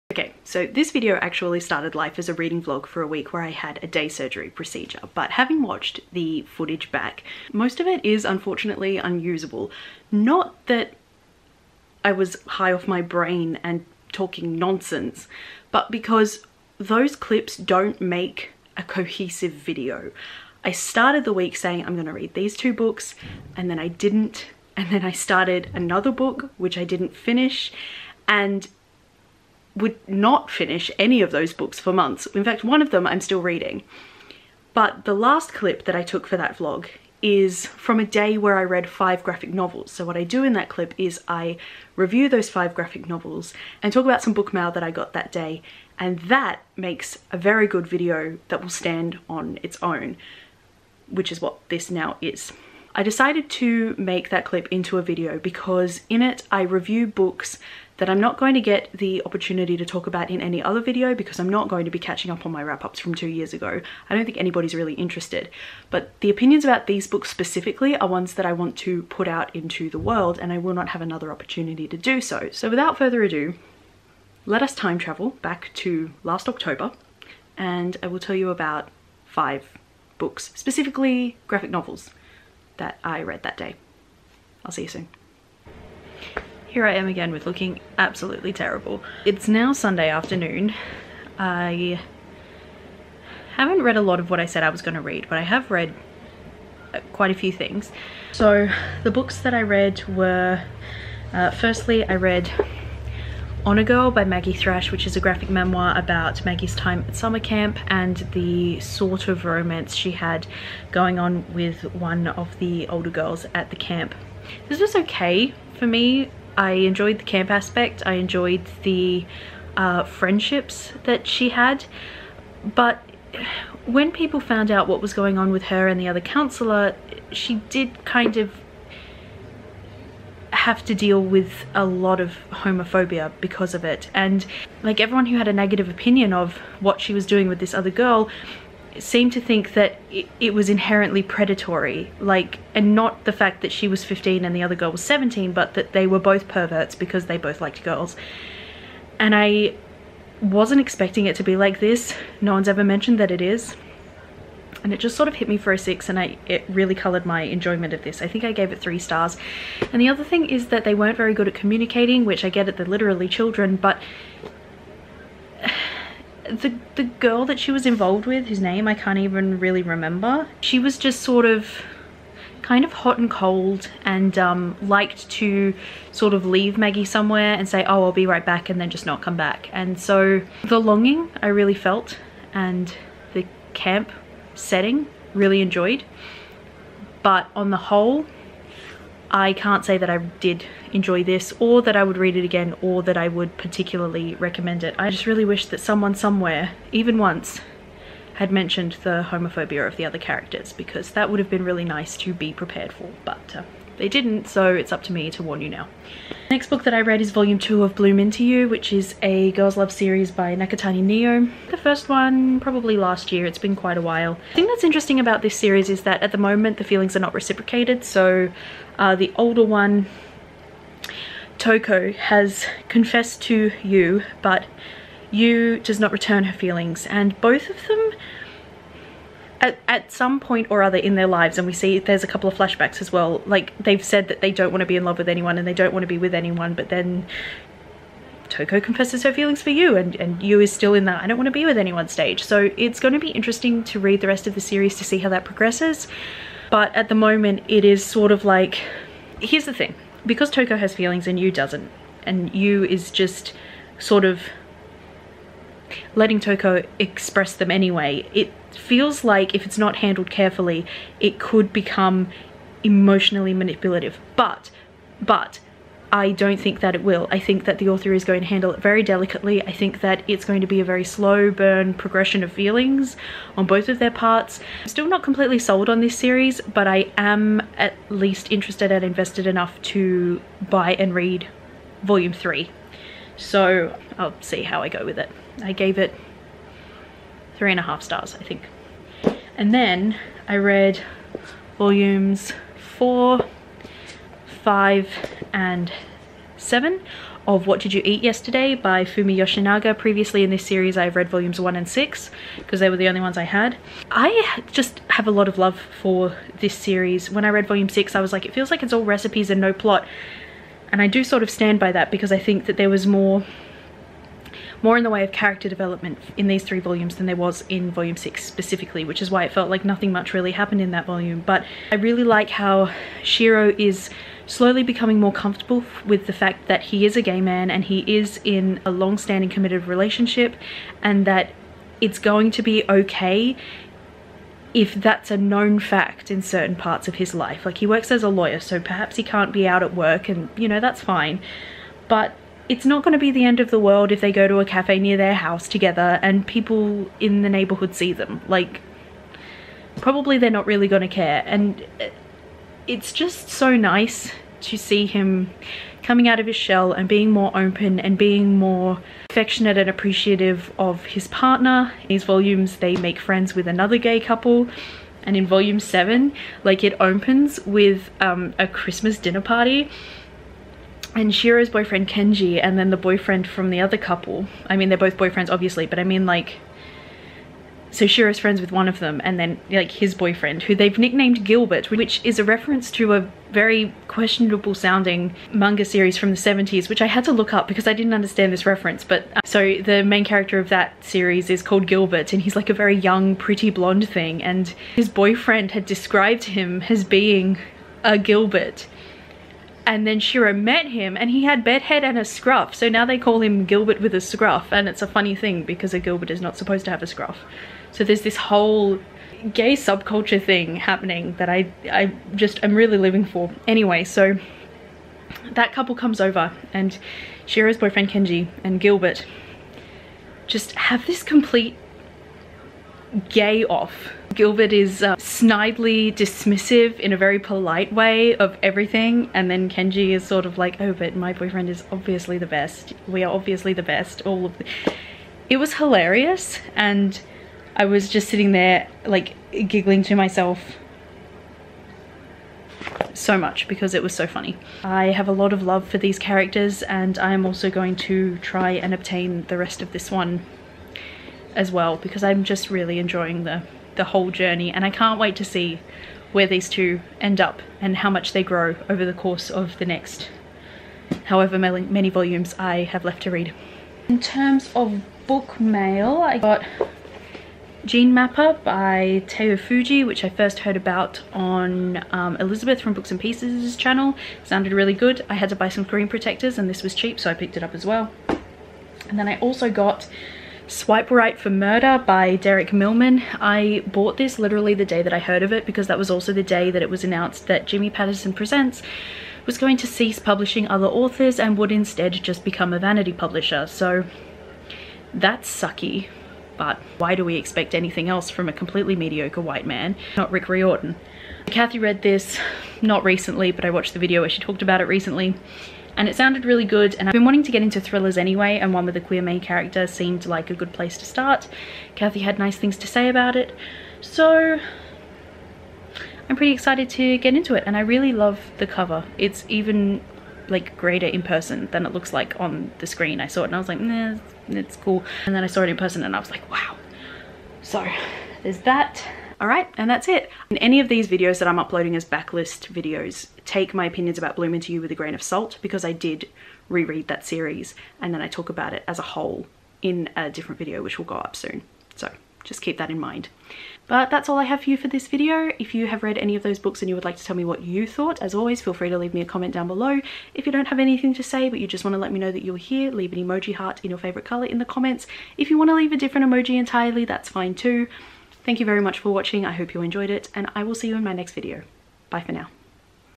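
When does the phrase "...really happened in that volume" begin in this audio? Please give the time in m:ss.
5:20.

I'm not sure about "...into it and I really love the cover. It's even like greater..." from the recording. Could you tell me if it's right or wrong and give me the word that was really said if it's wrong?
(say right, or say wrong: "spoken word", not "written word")
right.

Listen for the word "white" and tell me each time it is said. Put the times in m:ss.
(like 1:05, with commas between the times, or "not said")
8:19.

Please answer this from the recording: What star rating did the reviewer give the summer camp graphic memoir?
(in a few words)
3 stars.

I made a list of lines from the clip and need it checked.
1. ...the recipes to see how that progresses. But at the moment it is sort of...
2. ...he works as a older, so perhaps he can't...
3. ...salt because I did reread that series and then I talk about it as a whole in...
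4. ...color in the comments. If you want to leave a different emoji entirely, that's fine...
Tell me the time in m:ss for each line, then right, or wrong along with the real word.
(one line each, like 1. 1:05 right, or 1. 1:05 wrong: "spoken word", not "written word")
1. 4:04 wrong: "series", not "recipes"
2. 5:37 wrong: "lawyer", not "older"
3. 8:55 right
4. 9:14 right.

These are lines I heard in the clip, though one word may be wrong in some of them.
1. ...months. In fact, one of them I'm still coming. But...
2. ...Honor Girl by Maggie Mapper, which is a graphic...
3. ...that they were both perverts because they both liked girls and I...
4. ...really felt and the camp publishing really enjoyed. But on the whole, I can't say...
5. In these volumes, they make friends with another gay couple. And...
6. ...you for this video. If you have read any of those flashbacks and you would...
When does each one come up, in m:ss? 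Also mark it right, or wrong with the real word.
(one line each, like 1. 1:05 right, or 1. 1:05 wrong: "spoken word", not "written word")
1. 0:31 wrong: "reading", not "coming"
2. 1:43 wrong: "Thrash", not "Mapper"
3. 2:25 right
4. 3:01 wrong: "setting", not "publishing"
5. 6:02 right
6. 9:04 wrong: "books", not "flashbacks".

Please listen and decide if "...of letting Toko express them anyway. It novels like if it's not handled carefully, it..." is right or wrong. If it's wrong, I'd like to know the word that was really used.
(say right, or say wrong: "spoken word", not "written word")
wrong: "feels", not "novels".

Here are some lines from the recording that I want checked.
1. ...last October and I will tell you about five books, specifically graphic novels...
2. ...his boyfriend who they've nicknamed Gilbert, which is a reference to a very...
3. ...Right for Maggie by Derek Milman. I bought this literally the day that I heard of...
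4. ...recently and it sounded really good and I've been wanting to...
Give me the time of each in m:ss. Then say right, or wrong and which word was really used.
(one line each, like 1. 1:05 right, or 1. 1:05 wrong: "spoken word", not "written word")
1. 1:16 right
2. 6:19 right
3. 8:01 wrong: "Murder", not "Maggie"
4. 8:24 right.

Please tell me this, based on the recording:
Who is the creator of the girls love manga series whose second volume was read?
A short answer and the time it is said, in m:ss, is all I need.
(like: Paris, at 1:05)
Nakatani Nio, at 3:30.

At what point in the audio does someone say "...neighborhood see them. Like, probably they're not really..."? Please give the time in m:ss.
5:47.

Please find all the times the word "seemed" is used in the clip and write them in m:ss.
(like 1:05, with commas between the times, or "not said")
2:18, 8:29.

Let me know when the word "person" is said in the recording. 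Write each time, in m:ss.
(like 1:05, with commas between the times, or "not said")
8:41, 8:45.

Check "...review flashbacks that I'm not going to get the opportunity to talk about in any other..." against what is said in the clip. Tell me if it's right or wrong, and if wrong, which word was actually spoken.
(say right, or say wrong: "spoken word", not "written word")
wrong: "books", not "flashbacks".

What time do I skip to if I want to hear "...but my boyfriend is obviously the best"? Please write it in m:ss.
7:10.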